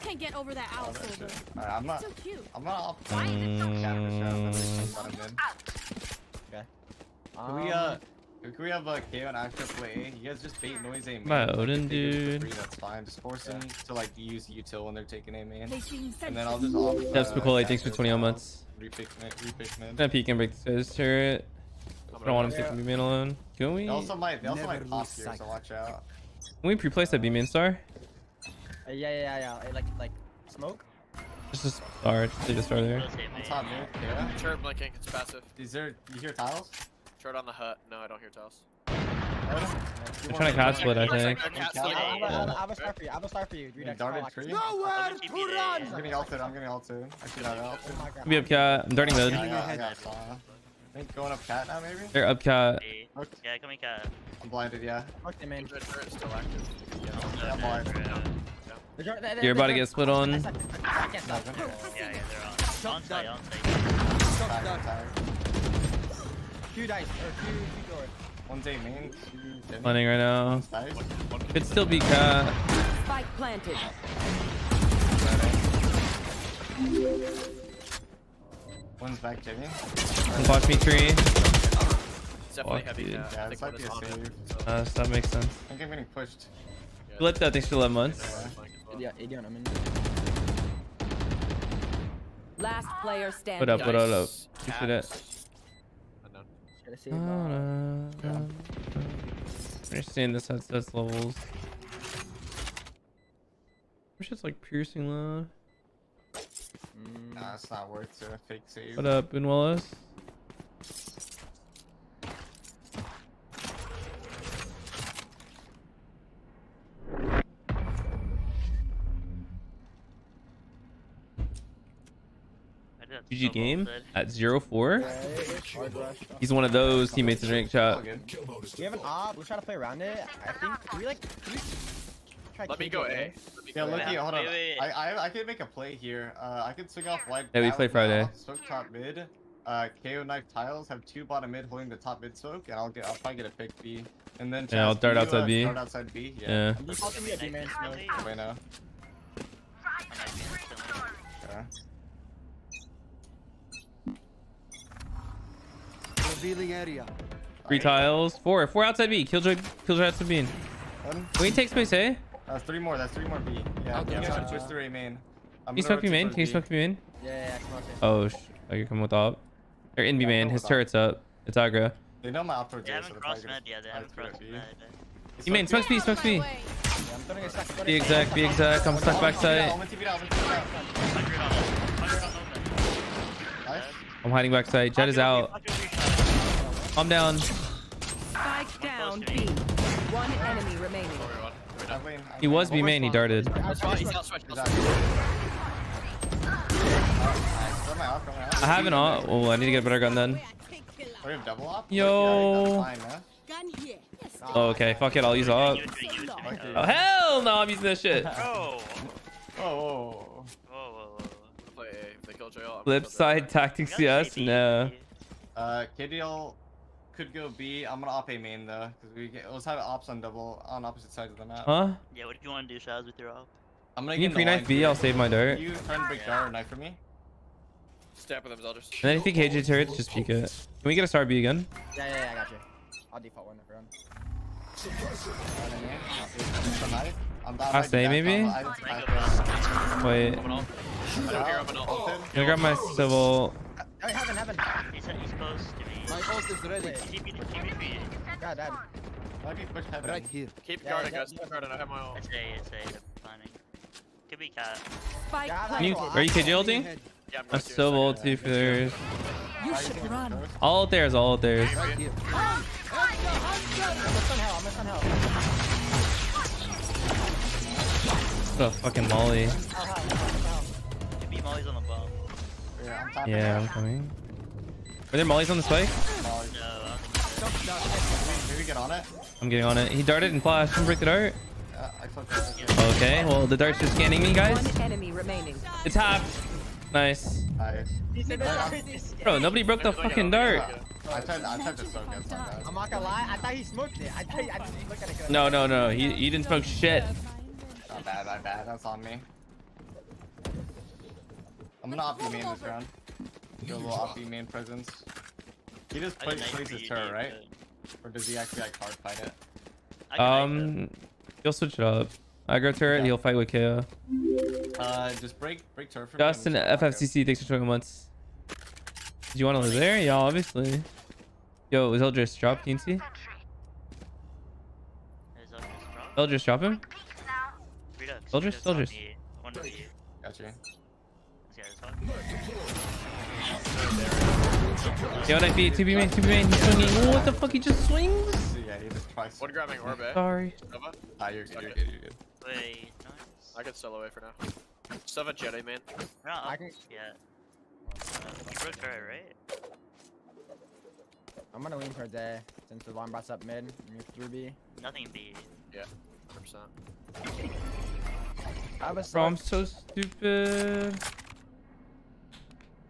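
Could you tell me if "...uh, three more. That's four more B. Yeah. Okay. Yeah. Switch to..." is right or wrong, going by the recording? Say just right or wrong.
wrong.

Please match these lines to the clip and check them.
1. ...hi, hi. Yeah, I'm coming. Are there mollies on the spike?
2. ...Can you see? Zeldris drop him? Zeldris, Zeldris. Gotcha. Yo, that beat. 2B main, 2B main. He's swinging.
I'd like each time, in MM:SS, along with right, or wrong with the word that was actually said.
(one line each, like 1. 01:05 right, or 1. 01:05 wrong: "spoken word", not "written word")
1. 04:29 right
2. 05:22 right.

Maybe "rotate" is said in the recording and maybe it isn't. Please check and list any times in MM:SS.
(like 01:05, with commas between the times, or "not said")
not said.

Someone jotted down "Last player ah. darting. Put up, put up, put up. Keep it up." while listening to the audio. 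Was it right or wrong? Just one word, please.
wrong.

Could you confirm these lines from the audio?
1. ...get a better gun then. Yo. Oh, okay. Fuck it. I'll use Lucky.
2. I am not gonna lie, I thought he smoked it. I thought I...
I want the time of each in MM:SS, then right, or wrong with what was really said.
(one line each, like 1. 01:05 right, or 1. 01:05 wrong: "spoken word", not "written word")
1. 03:19 wrong: "AWP", not "Lucky"
2. 04:51 right.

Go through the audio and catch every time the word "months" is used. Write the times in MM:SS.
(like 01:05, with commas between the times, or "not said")
00:18, 01:27, 05:17.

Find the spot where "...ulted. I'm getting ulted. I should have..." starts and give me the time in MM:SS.
00:46.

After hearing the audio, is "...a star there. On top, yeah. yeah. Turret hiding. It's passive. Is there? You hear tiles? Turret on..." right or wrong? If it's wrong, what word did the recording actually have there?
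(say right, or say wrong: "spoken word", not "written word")
wrong: "blinking", not "hiding".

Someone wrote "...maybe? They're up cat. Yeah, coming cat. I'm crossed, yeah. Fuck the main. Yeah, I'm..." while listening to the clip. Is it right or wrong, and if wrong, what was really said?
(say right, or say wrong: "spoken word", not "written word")
wrong: "blinded", not "crossed".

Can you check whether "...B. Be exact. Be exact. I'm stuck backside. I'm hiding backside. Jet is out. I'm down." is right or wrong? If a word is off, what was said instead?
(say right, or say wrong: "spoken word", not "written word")
right.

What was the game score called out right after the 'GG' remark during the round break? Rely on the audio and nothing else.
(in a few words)
0-4.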